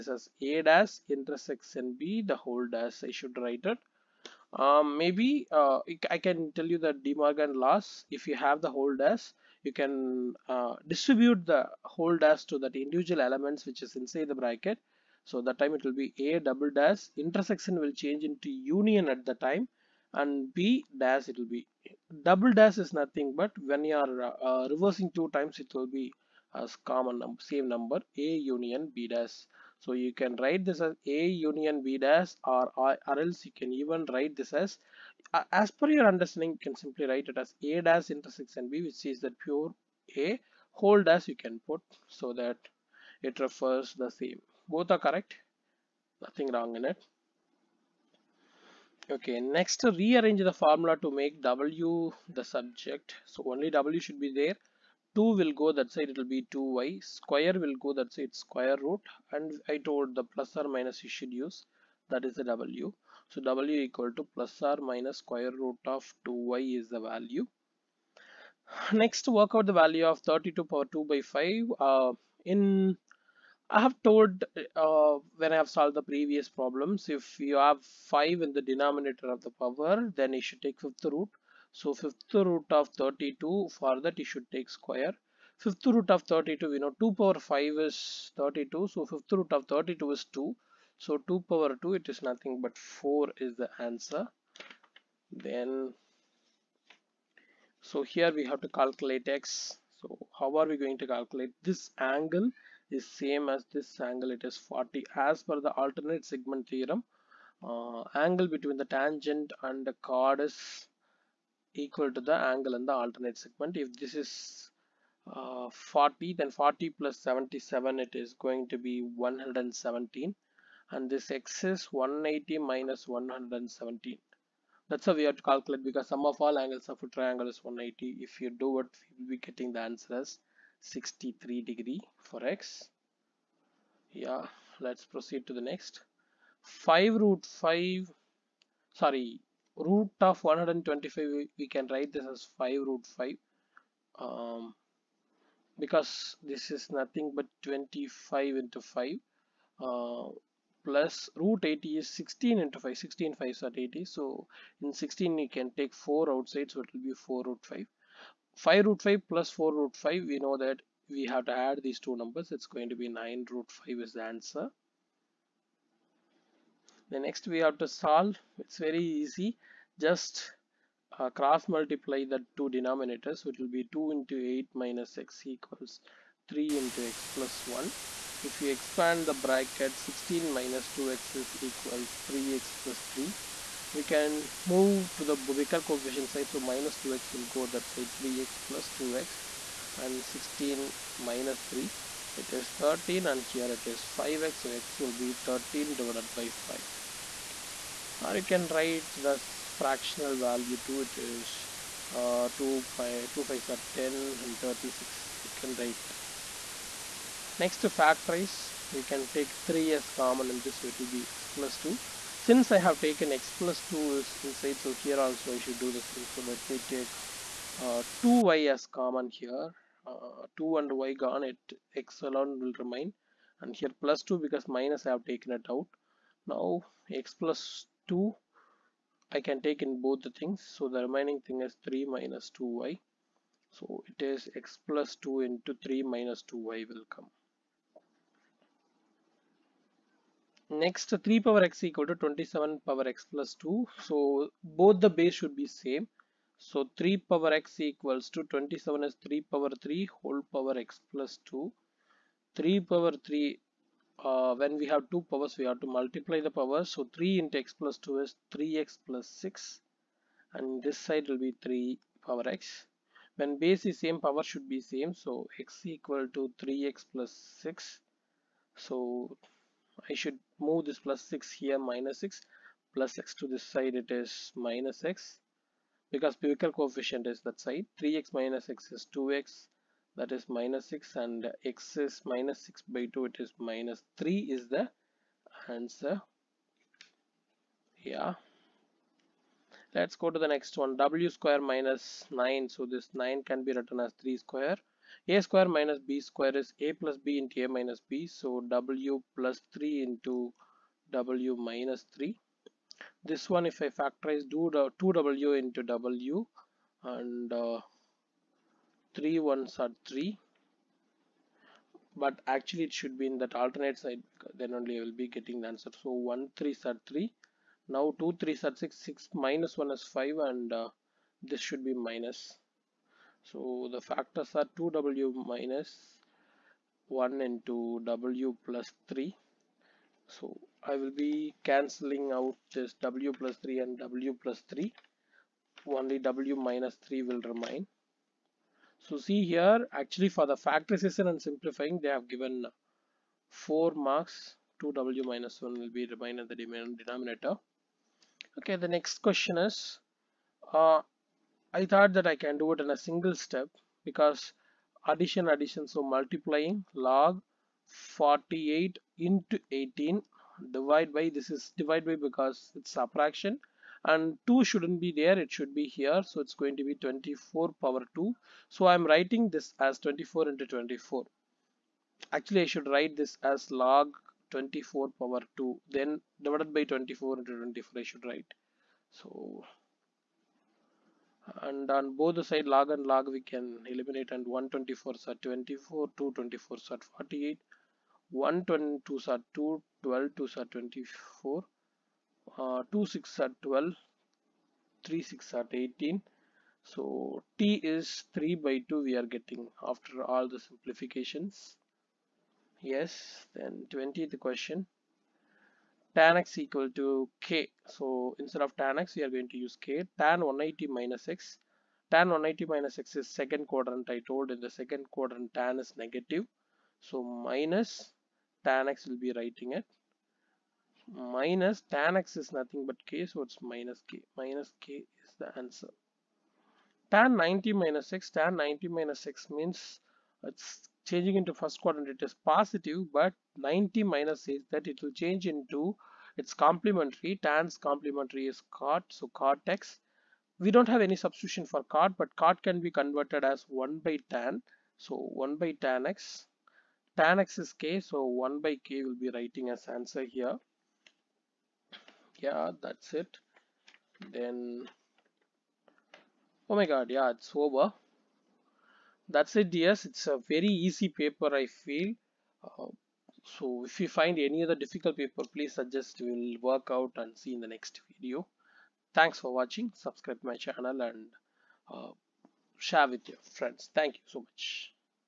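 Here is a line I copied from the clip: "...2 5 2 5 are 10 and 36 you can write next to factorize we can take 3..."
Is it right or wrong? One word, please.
right.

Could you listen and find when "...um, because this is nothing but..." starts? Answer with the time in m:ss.
2:24.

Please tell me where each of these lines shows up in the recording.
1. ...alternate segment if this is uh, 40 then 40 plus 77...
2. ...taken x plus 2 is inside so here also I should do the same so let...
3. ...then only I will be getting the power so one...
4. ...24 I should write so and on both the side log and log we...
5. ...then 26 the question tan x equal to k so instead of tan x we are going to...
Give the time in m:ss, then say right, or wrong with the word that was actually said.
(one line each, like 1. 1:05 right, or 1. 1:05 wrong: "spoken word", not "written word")
1. 1:52 right
2. 3:32 right
3. 5:14 wrong: "answer", not "power"
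4. 6:17 right
5. 6:43 wrong: "20", not "26".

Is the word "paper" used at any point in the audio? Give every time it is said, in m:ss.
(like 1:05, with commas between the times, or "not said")
7:41, 7:45.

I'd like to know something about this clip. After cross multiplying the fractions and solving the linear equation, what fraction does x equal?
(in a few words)
13/5.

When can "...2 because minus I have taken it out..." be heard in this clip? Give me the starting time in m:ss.
3:44.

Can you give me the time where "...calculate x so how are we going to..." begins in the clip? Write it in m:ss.
1:38.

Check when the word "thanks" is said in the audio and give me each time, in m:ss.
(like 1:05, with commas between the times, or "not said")
7:49, 7:53.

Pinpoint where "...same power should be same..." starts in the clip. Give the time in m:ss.
4:24.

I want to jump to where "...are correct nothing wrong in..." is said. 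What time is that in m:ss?
0:44.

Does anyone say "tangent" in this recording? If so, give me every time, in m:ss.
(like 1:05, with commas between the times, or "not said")
1:48.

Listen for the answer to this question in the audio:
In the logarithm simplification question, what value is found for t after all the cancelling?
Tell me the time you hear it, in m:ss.
6:38.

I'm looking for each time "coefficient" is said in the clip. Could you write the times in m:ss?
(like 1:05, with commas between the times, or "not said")
3:05, 4:36.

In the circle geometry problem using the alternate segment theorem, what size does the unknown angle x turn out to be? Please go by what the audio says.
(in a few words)
63 degrees.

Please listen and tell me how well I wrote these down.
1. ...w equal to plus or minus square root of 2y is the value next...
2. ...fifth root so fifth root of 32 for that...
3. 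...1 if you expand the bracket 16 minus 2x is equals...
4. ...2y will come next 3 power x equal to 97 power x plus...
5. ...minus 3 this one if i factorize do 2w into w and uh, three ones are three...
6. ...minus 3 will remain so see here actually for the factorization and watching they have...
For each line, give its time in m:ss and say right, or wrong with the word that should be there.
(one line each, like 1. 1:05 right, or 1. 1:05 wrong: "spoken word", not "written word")
1. 1:03 right
2. 1:20 right
3. 2:57 right
4. 3:56 wrong: "27", not "97"
5. 5:01 right
6. 5:36 wrong: "simplifying", not "watching".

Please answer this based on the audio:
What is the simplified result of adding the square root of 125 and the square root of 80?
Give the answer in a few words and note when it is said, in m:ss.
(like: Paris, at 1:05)
9 root 5, at 2:43.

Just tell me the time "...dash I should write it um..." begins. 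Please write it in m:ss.
0:02.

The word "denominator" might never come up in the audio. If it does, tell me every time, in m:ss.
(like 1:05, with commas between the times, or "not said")
1:18, 2:52, 5:46.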